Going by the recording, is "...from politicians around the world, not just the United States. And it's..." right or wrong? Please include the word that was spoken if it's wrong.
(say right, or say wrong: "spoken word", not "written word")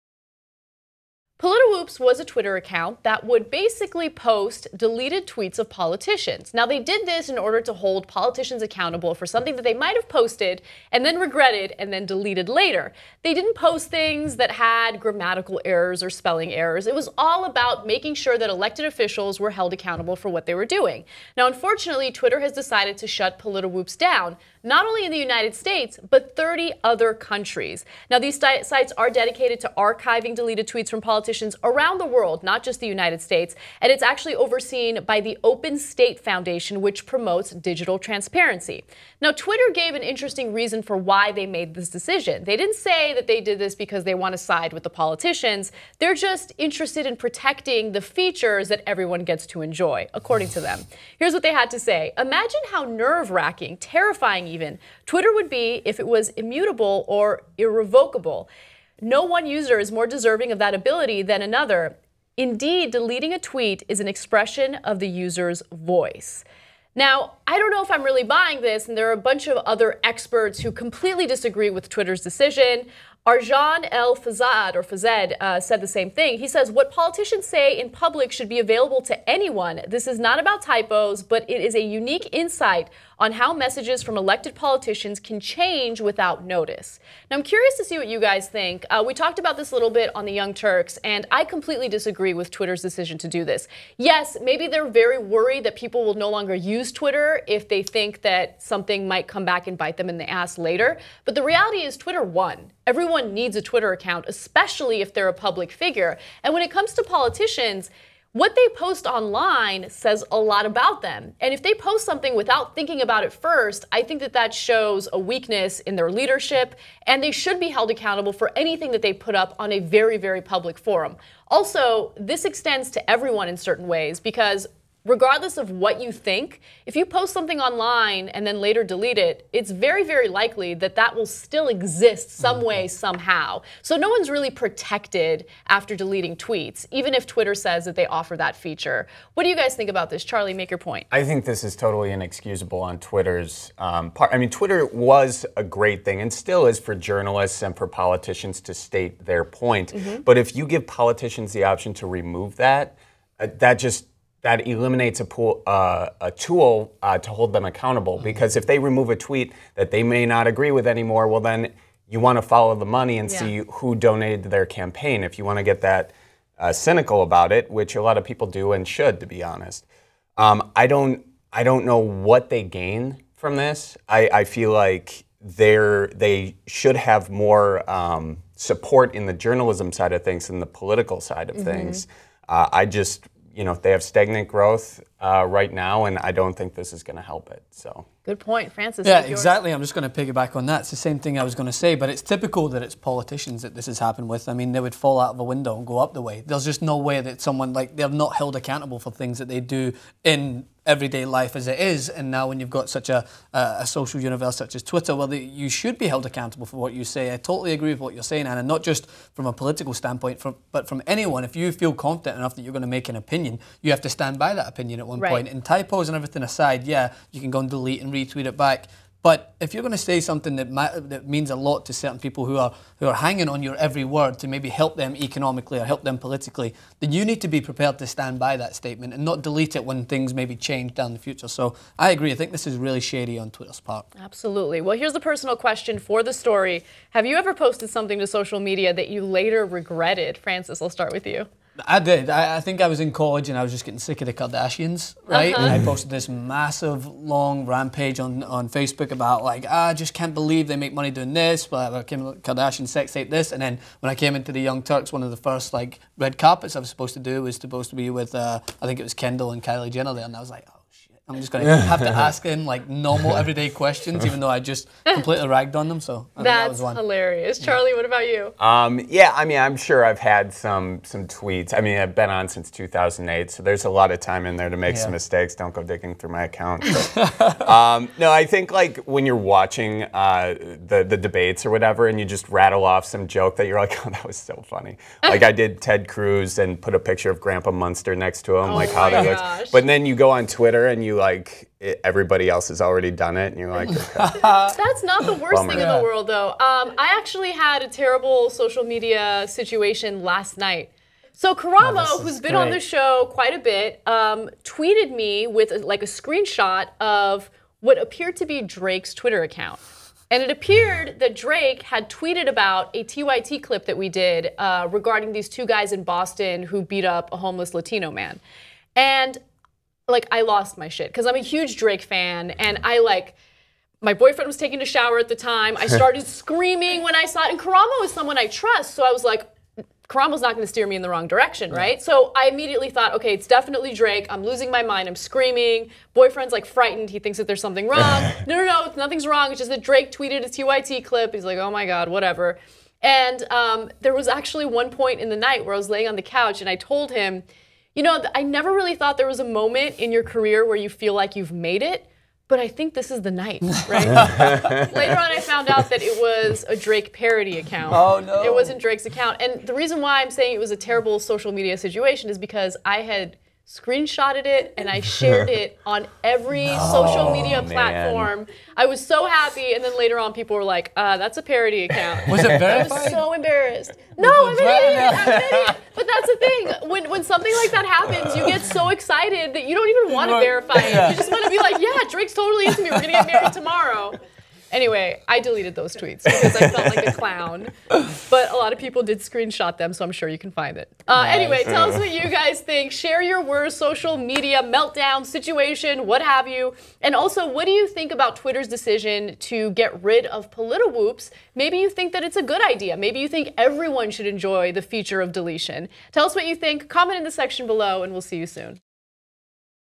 right.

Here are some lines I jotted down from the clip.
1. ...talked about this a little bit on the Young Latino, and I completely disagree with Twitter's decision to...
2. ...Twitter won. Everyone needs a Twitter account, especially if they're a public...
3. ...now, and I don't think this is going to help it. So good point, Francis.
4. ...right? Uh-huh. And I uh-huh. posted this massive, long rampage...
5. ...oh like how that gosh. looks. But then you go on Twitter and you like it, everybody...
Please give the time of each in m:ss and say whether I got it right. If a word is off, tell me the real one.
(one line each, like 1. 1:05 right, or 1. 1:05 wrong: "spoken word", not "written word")
1. 1:29 wrong: "Turks", not "Latino"
2. 1:41 right
3. 3:05 right
4. 4:05 right
5. 4:48 right.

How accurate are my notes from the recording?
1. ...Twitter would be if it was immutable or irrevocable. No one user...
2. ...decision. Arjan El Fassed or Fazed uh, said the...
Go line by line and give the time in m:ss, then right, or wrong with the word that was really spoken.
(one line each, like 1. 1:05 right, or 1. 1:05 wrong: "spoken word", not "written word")
1. 0:55 right
2. 1:12 right.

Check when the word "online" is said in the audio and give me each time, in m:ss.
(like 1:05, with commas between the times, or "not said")
1:49, 2:07.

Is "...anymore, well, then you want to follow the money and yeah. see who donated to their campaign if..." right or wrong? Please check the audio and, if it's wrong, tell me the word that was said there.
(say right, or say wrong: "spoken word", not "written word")
right.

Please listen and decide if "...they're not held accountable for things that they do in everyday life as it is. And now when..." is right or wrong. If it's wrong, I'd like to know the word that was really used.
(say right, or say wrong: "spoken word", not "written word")
right.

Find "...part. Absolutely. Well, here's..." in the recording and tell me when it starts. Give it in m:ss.
3:53.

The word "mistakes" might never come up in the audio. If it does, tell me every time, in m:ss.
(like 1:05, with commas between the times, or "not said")
4:35.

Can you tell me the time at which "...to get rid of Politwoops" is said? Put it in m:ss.
6:39.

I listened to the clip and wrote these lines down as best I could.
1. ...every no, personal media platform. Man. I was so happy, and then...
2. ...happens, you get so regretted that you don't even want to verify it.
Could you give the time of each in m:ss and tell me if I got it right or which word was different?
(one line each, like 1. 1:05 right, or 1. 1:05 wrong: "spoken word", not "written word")
1. 6:06 wrong: "social", not "personal"
2. 6:17 wrong: "excited", not "regretted".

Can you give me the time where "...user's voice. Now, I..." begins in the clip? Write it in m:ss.
1:05.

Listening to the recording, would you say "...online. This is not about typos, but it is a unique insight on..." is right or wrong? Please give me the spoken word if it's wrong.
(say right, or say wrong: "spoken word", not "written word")
wrong: "anyone", not "online".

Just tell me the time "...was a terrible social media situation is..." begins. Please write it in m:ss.
6:00.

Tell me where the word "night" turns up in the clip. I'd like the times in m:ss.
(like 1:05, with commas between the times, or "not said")
5:00, 5:45, 5:53.